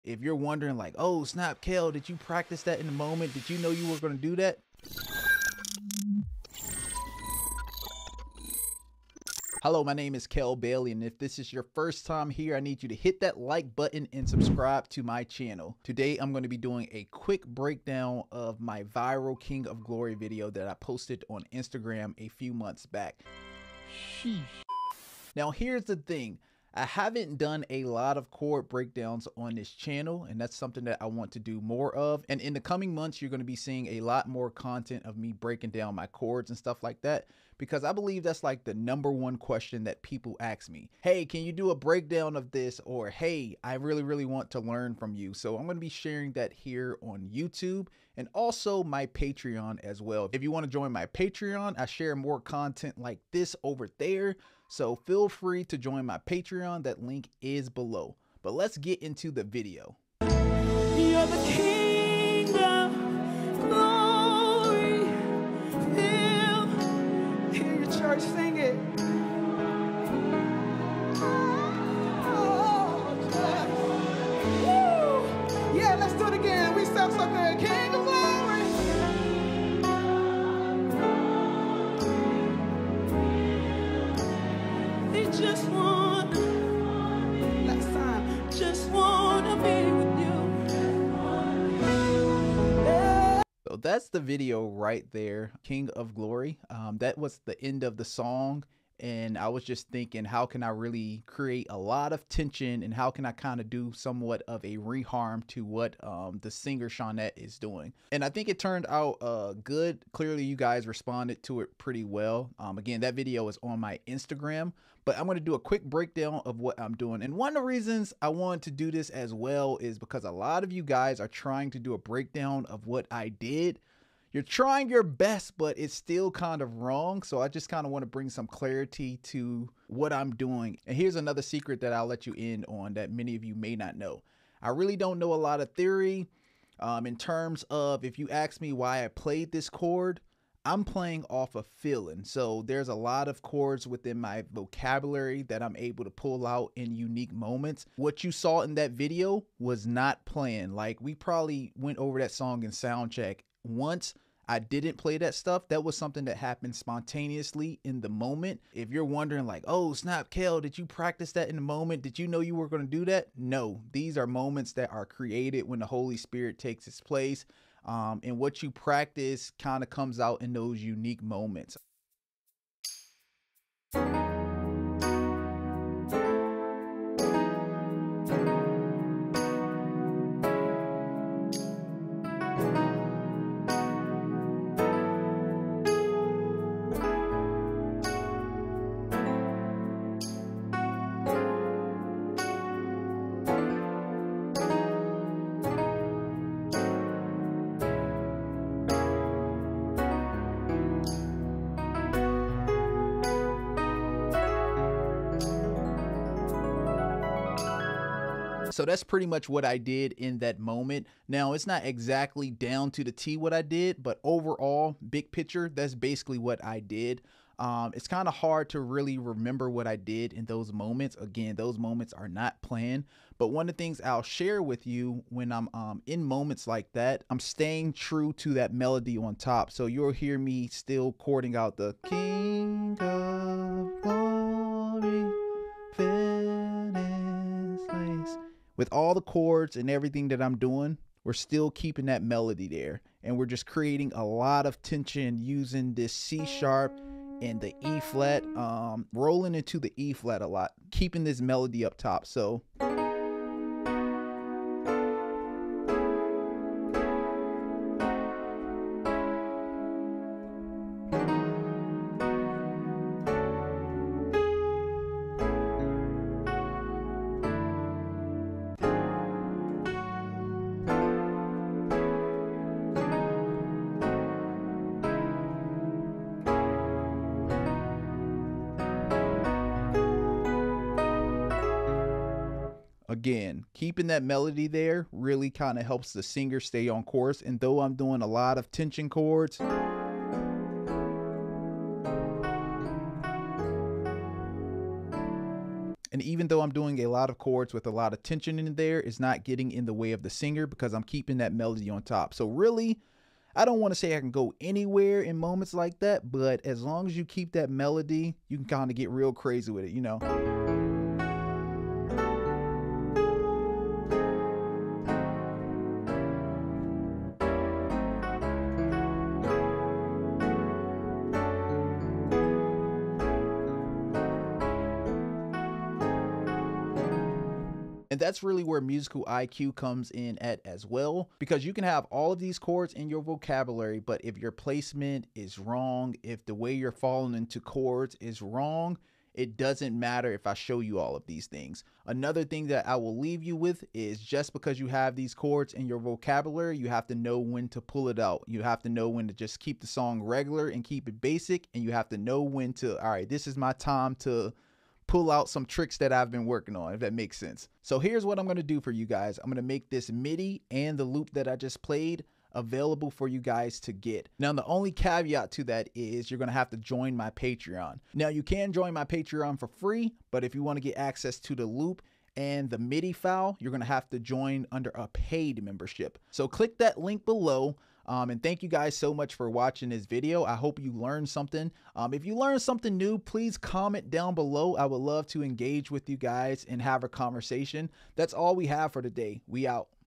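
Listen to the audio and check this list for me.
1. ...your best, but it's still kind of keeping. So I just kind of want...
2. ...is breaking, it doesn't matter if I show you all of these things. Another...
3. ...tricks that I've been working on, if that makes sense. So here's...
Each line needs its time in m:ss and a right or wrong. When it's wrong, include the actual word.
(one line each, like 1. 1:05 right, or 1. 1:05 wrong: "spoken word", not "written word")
1. 2:04 wrong: "wrong", not "keeping"
2. 5:38 wrong: "wrong", not "breaking"
3. 5:55 right.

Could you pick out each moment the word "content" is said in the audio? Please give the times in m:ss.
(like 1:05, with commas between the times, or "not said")
0:34, 0:52.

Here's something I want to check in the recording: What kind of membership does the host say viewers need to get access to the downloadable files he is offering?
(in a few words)
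Paid membership.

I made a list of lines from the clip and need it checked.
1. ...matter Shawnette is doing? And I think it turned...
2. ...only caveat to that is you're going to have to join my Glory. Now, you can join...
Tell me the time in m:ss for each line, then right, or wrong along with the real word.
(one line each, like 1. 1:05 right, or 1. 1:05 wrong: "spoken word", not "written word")
1. 1:46 wrong: "singer", not "matter"
2. 6:04 wrong: "Patreon", not "Glory".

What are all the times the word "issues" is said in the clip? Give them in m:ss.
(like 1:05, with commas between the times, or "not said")
not said.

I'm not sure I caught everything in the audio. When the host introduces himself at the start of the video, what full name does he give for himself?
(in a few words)
Kell Bailey.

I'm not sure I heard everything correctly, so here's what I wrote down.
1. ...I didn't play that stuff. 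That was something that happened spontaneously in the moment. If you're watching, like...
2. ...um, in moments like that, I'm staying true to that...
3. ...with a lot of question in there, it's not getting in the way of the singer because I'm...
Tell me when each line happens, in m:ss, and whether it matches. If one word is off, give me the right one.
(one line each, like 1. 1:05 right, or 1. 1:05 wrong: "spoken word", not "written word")
1. 2:34 wrong: "wondering", not "watching"
2. 3:45 right
3. 4:57 wrong: "tension", not "question".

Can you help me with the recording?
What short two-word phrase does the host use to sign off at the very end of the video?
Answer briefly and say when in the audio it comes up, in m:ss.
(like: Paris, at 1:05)
We out, at 6:29.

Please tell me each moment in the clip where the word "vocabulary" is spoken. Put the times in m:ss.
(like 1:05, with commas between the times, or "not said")
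2:24, 5:33, 5:45.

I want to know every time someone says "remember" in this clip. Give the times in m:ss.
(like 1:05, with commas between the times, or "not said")
3:39.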